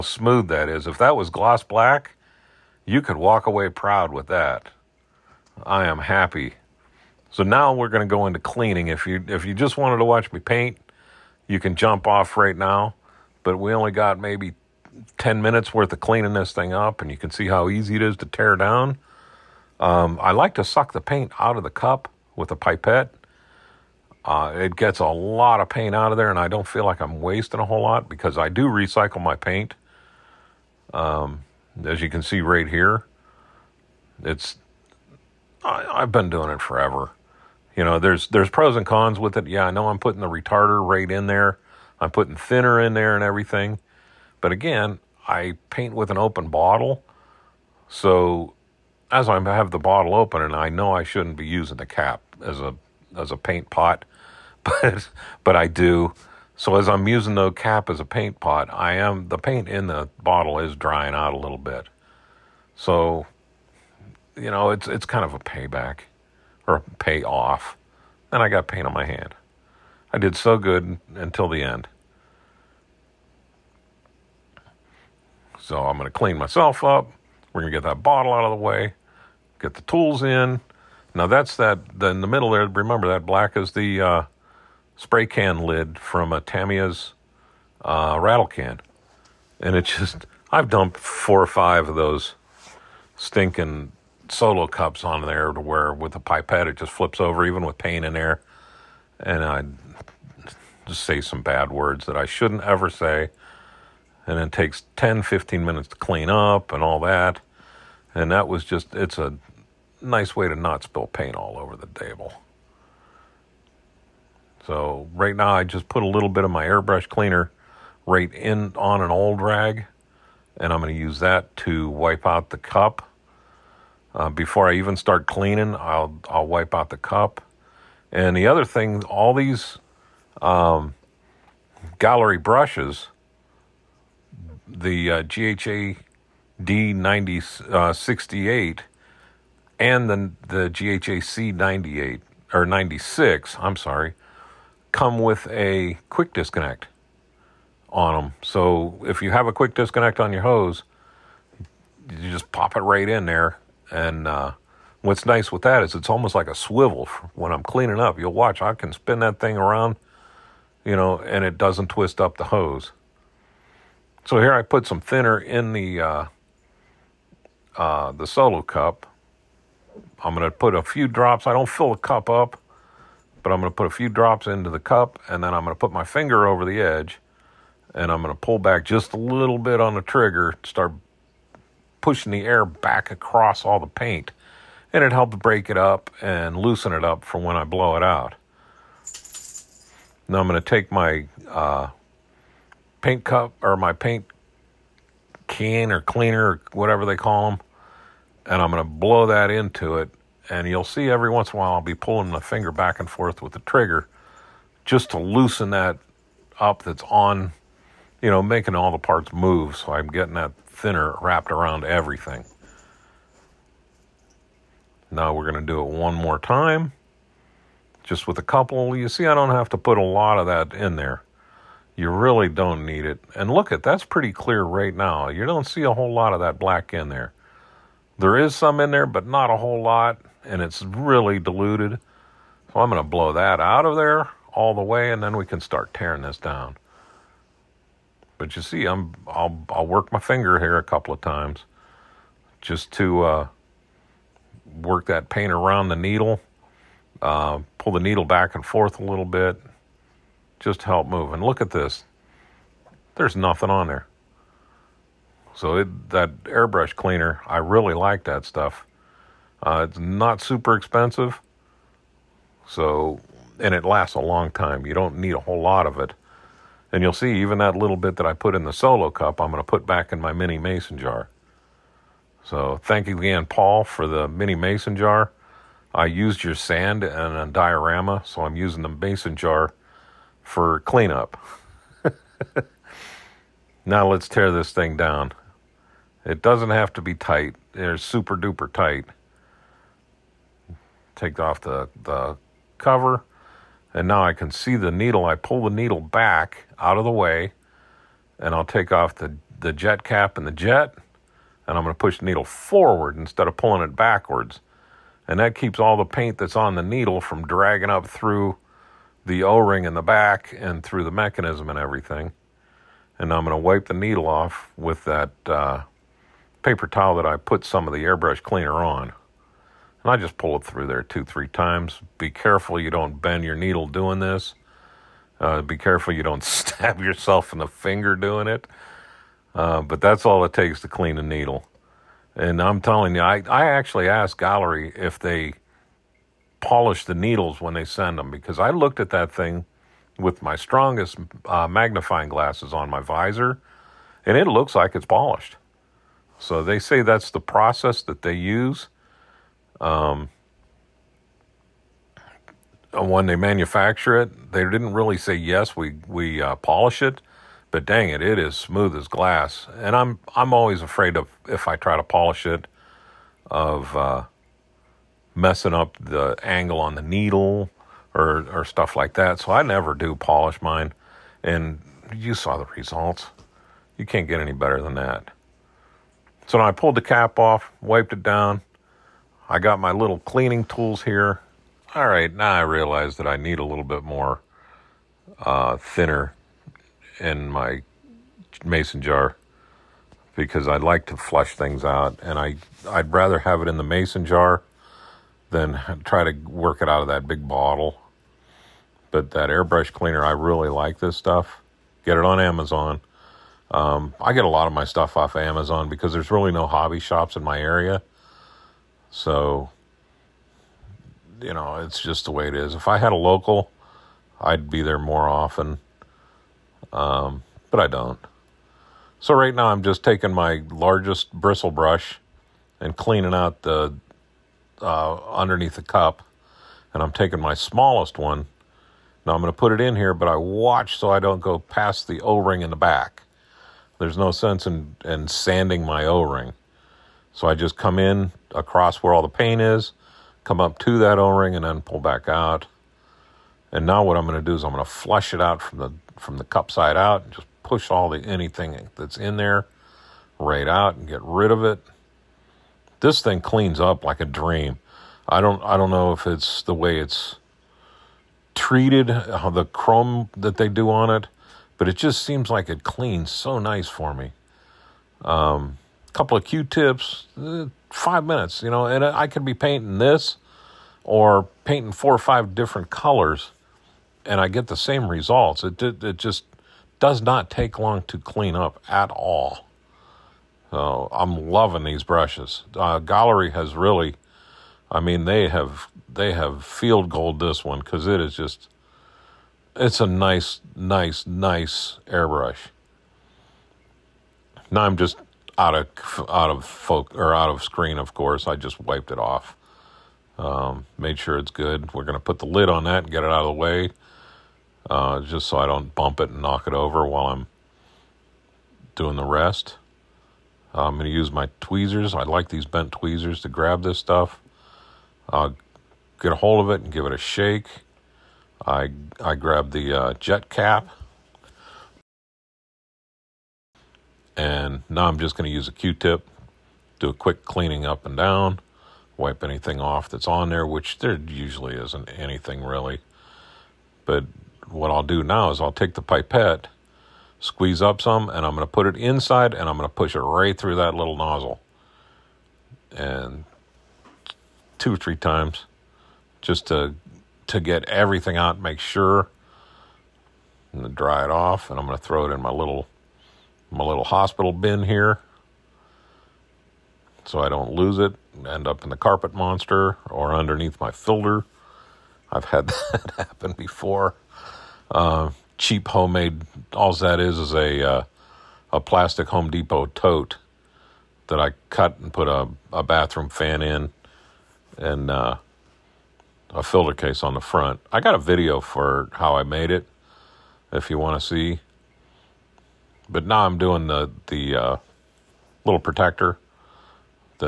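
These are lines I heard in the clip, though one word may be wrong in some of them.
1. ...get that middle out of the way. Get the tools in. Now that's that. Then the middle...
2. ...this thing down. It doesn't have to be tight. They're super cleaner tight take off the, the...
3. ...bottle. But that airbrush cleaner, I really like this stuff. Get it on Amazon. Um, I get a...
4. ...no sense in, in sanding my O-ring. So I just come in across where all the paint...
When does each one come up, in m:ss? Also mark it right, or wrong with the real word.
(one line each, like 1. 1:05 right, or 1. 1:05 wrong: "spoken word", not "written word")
1. 1:17 wrong: "bottle", not "middle"
2. 4:44 wrong: "duper", not "cleaner"
3. 6:37 right
4. 7:14 right.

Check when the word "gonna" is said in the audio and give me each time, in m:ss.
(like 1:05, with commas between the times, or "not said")
8:22, 8:30.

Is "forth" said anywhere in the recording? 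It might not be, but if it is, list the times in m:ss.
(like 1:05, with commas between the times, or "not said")
3:23, 4:08.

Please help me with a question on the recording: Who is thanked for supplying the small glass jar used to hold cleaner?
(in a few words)
Paul.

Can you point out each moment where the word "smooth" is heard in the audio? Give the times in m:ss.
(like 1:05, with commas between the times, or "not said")
0:00, 5:58.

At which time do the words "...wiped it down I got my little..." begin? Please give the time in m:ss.
6:17.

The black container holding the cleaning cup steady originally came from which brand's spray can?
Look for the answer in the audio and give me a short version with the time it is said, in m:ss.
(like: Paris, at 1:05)
Tamiya, at 1:26.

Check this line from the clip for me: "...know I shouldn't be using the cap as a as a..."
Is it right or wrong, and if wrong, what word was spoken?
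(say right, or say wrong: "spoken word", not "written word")
right.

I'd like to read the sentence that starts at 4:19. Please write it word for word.
Uh, it's not super expensive, so and it lasts a long time.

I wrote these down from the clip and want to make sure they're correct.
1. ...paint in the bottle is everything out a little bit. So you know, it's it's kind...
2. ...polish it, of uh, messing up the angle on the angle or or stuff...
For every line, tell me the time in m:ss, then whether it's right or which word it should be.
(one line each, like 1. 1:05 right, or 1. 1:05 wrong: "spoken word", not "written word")
1. 0:59 wrong: "drying", not "everything"
2. 6:02 wrong: "needle", not "angle".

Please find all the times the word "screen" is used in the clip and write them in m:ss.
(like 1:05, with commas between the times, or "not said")
8:17.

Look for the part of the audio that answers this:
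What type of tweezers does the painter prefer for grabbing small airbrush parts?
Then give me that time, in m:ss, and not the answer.
8:32.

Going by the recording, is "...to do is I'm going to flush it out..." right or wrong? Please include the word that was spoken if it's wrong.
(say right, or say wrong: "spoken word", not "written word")
right.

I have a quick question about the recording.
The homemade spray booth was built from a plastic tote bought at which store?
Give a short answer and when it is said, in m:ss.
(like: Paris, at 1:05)
Home Depot, at 9:29.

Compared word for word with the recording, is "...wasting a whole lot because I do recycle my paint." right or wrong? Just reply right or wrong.
right.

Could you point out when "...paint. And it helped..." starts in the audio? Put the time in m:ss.
3:03.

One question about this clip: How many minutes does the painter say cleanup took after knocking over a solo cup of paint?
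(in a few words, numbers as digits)
10 to 15.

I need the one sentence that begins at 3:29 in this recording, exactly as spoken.
So I'm getting that thinner wrapped around everything.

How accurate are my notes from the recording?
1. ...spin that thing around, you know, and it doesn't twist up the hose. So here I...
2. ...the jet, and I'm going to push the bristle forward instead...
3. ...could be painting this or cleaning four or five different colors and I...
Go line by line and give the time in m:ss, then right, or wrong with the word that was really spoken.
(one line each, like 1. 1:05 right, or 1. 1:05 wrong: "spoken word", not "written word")
1. 2:38 right
2. 5:00 wrong: "needle", not "bristle"
3. 7:49 wrong: "painting", not "cleaning".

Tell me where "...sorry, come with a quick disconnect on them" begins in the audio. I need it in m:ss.
2:23.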